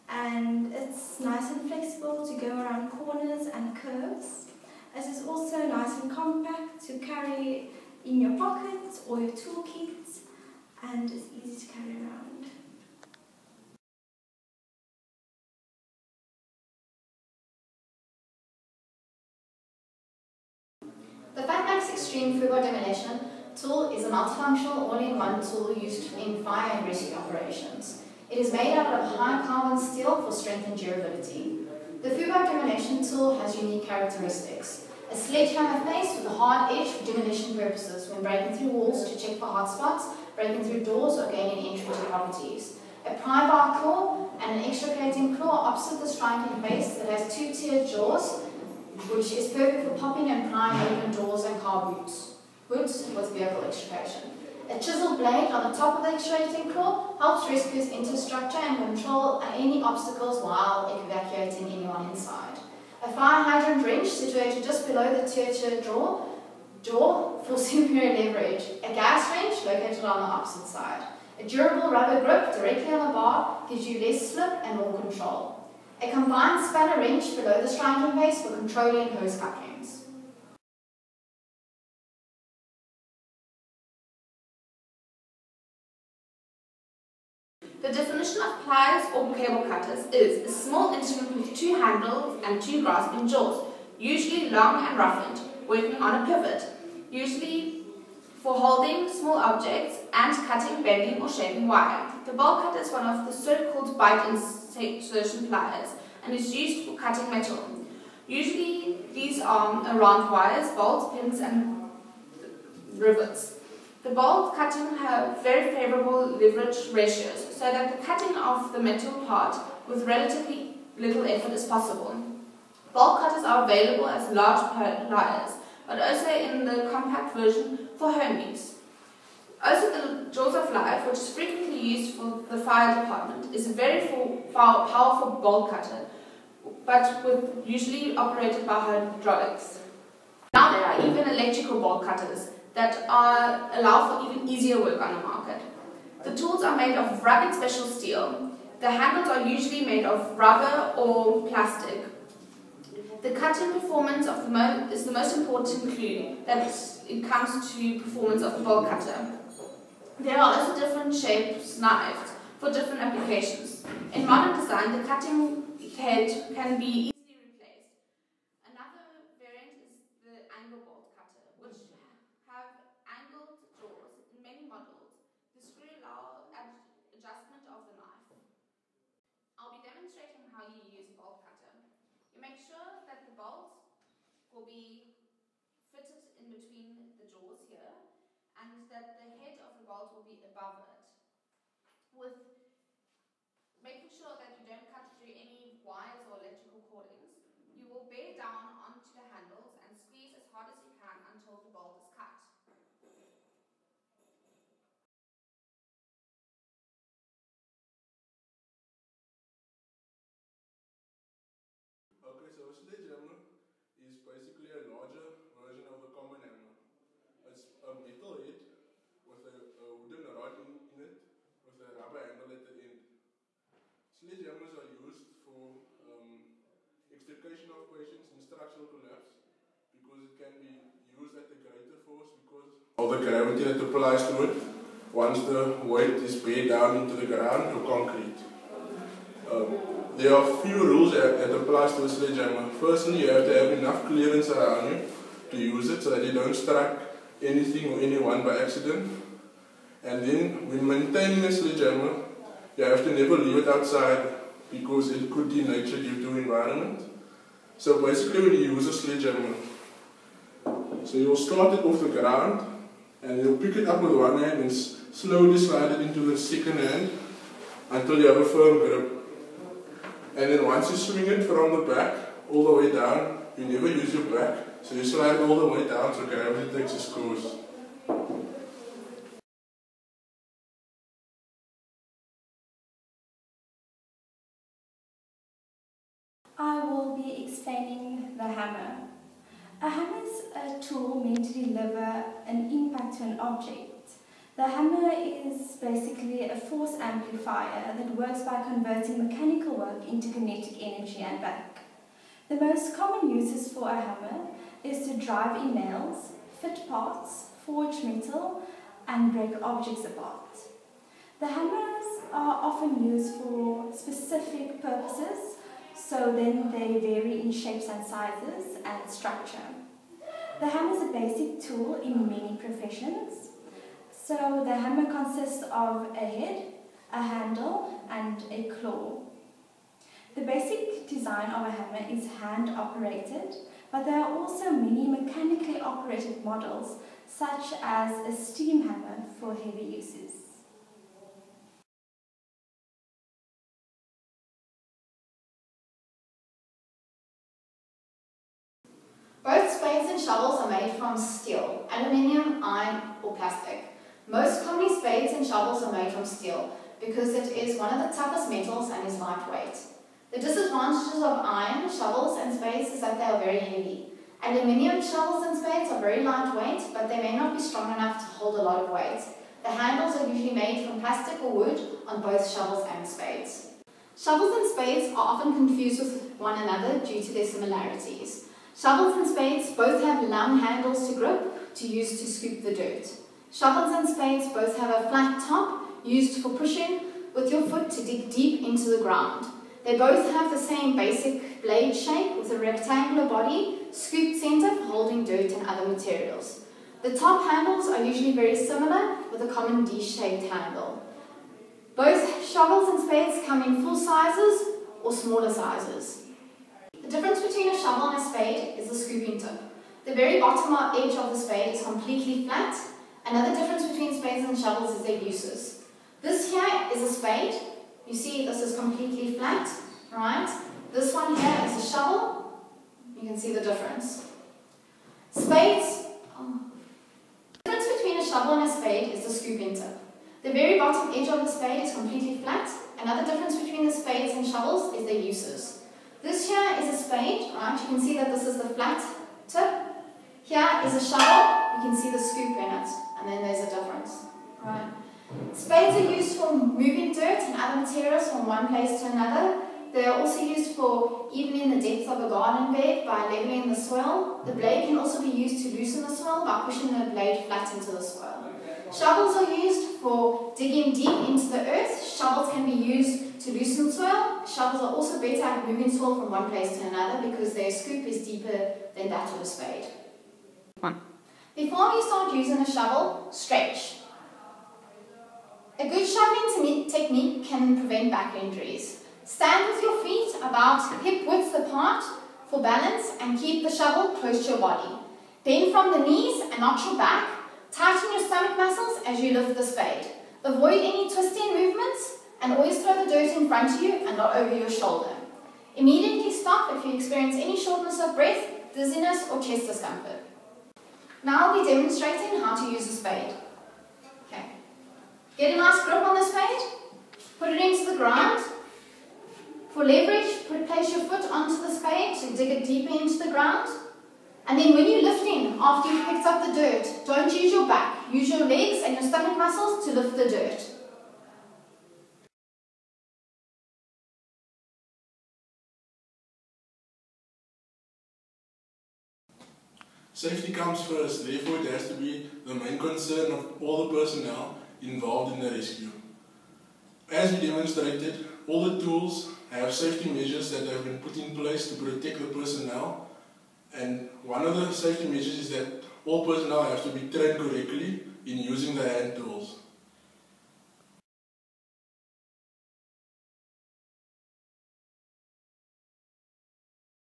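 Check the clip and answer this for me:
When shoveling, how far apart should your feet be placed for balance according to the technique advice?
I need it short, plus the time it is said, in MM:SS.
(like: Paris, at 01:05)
hip width apart, at 08:01.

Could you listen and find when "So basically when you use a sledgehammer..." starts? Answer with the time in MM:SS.
04:17.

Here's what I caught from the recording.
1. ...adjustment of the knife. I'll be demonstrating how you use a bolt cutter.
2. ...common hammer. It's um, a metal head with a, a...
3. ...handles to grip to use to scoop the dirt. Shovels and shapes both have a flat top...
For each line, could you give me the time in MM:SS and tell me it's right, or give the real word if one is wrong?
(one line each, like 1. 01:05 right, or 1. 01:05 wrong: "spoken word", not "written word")
1. 02:57 right
2. 03:36 right
3. 06:20 wrong: "spades", not "shapes".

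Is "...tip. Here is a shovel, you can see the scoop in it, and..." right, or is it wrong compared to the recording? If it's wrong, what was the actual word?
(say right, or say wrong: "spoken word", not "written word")
right.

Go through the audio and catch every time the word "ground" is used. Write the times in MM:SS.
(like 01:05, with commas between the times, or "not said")
03:57, 04:22, 06:29, 08:27, 08:33.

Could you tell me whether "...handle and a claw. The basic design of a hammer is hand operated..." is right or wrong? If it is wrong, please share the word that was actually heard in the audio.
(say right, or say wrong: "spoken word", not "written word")
right.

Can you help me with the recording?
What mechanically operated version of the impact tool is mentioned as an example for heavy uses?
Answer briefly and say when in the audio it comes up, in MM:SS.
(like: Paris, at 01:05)
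steam hammer, at 05:38.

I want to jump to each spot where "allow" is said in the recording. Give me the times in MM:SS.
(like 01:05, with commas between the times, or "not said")
02:23, 02:55.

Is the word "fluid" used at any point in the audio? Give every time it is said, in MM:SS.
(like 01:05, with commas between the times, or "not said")
00:22.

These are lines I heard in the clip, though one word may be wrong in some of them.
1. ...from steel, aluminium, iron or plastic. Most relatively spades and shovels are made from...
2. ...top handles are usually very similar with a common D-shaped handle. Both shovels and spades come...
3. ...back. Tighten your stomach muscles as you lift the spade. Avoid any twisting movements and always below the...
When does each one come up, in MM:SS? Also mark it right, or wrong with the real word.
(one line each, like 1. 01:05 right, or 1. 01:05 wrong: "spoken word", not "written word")
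1. 05:50 wrong: "commonly", not "relatively"
2. 06:37 right
3. 08:06 wrong: "throw", not "below".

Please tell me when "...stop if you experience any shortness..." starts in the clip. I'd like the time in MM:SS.
08:16.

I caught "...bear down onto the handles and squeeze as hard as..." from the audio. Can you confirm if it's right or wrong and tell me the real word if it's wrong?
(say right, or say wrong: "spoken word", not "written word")
right.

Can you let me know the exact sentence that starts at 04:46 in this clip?
I will be explaining the hammer.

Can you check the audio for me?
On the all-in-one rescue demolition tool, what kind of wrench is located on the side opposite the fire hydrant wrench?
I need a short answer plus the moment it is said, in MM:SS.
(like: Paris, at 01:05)
gas wrench, at 01:08.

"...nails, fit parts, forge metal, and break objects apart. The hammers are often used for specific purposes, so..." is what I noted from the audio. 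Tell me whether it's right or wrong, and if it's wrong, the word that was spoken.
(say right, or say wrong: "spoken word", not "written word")
right.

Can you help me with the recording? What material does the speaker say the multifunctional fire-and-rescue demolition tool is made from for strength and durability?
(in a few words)
high carbon steel.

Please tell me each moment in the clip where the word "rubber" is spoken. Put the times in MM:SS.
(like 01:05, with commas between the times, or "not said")
01:11, 02:30, 03:41.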